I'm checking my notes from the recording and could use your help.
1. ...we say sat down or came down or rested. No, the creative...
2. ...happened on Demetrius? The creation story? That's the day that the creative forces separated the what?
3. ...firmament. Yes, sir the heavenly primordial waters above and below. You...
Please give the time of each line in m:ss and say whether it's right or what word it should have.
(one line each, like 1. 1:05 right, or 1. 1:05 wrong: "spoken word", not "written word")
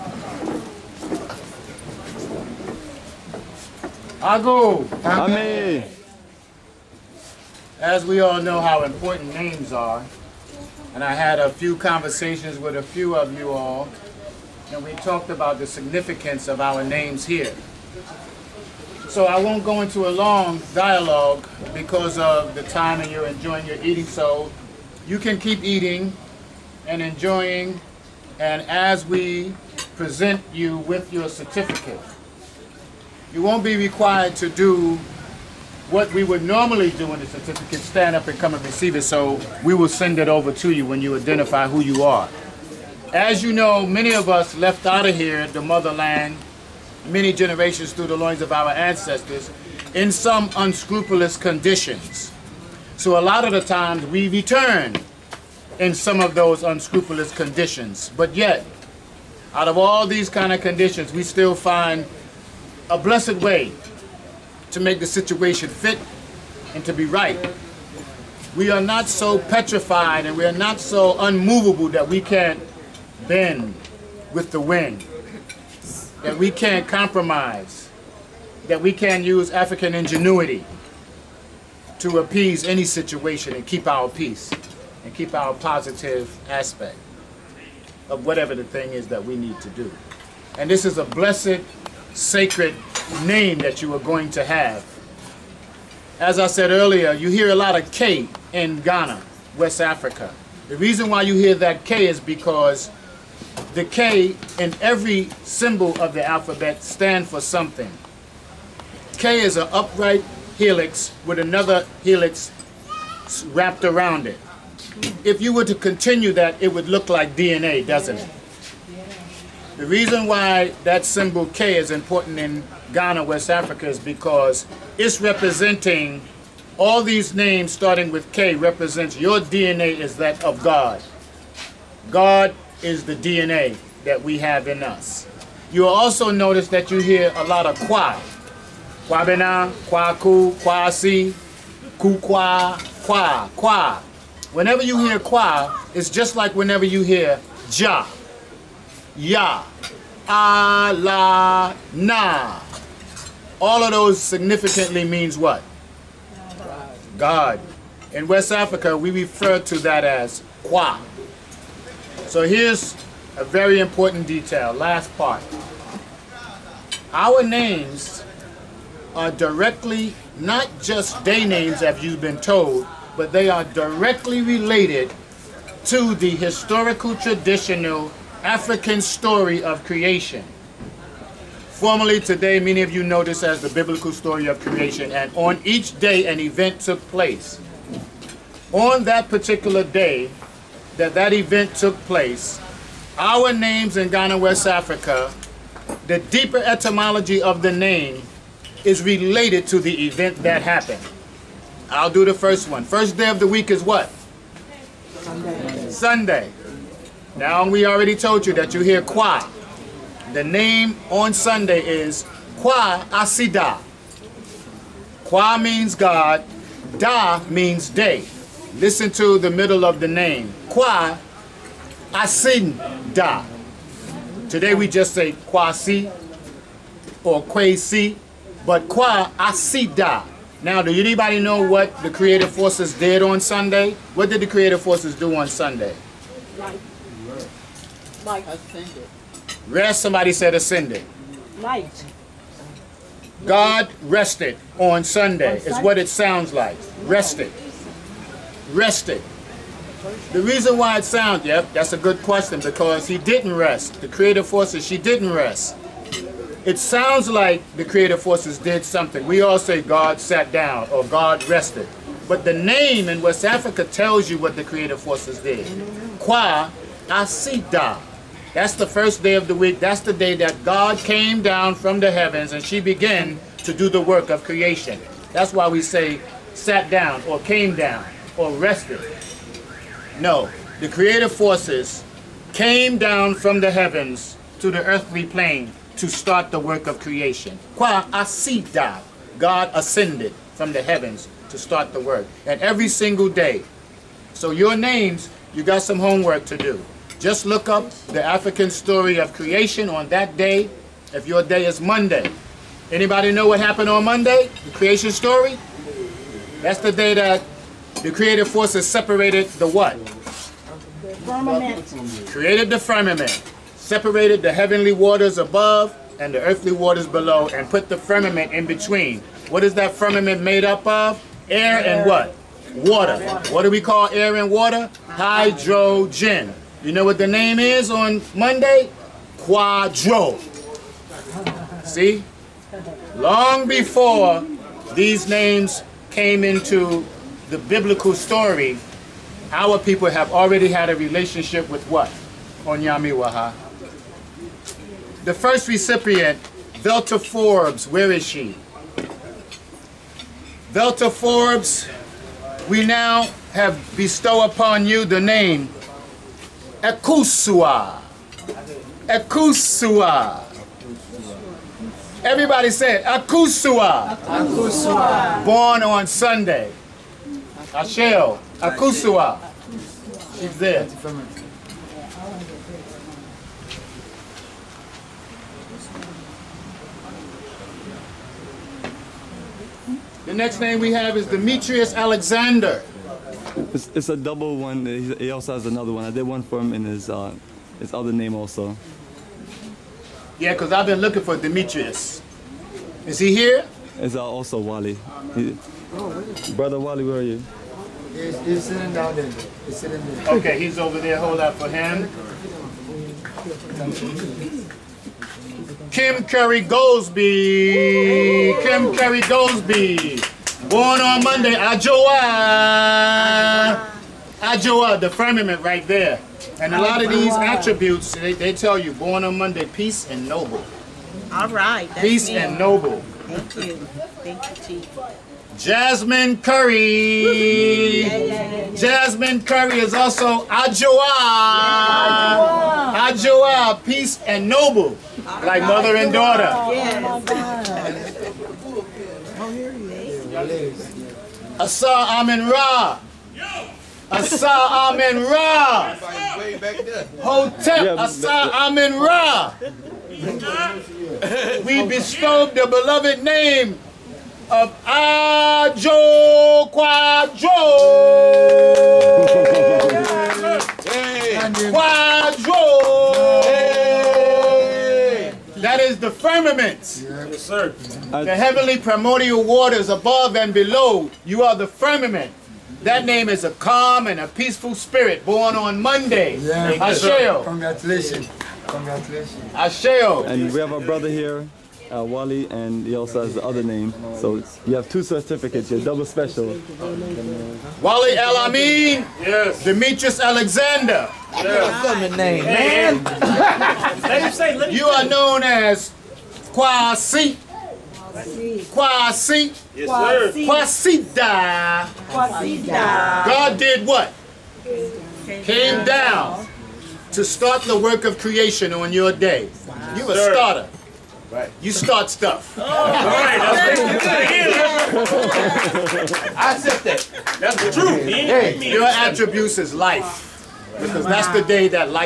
1. 4:35 right
2. 5:03 wrong: "Monday", not "Demetrius"
3. 7:46 right.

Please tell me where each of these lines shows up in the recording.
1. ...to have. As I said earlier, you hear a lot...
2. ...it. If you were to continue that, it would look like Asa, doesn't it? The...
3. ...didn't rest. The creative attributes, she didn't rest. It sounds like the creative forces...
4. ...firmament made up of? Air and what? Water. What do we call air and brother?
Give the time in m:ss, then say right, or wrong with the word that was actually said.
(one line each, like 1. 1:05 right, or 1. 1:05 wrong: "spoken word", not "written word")
1. 1:34 right
2. 1:54 wrong: "DNA", not "Asa"
3. 4:13 wrong: "forces", not "attributes"
4. 5:19 wrong: "water", not "brother".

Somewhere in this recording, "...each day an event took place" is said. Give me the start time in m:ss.
3:05.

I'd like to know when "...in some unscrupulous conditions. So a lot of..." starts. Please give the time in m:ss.
0:49.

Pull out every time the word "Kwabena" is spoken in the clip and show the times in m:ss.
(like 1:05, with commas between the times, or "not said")
2:19.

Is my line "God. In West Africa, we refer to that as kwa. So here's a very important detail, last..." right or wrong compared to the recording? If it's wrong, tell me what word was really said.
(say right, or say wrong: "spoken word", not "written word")
right.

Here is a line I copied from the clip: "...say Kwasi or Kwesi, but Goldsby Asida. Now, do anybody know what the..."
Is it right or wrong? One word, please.
wrong.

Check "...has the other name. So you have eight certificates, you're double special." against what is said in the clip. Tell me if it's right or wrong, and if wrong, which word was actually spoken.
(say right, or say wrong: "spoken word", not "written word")
wrong: "two", not "eight".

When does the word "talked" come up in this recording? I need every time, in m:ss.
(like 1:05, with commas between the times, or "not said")
0:14.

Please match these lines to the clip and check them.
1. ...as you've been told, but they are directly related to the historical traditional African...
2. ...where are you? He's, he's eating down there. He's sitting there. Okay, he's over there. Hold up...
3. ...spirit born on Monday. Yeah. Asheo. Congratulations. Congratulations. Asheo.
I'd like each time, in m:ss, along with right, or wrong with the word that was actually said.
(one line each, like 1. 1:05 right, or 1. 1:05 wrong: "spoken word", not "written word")
1. 2:51 right
2. 6:37 wrong: "sitting", not "eating"
3. 7:54 right.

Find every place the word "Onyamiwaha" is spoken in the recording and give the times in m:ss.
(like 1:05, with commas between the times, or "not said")
5:42.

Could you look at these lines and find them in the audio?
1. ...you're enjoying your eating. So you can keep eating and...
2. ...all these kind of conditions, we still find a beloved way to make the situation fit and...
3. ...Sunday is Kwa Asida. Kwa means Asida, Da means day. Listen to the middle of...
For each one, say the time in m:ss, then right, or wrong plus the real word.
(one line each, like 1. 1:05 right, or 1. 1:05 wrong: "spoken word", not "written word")
1. 0:23 right
2. 0:59 wrong: "blessed", not "beloved"
3. 3:31 wrong: "God", not "Asida".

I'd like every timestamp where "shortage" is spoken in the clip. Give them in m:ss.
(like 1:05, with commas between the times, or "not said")
not said.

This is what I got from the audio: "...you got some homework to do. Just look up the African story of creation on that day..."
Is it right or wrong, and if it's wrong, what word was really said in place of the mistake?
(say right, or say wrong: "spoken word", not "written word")
right.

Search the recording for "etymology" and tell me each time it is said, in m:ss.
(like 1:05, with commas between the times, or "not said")
3:16.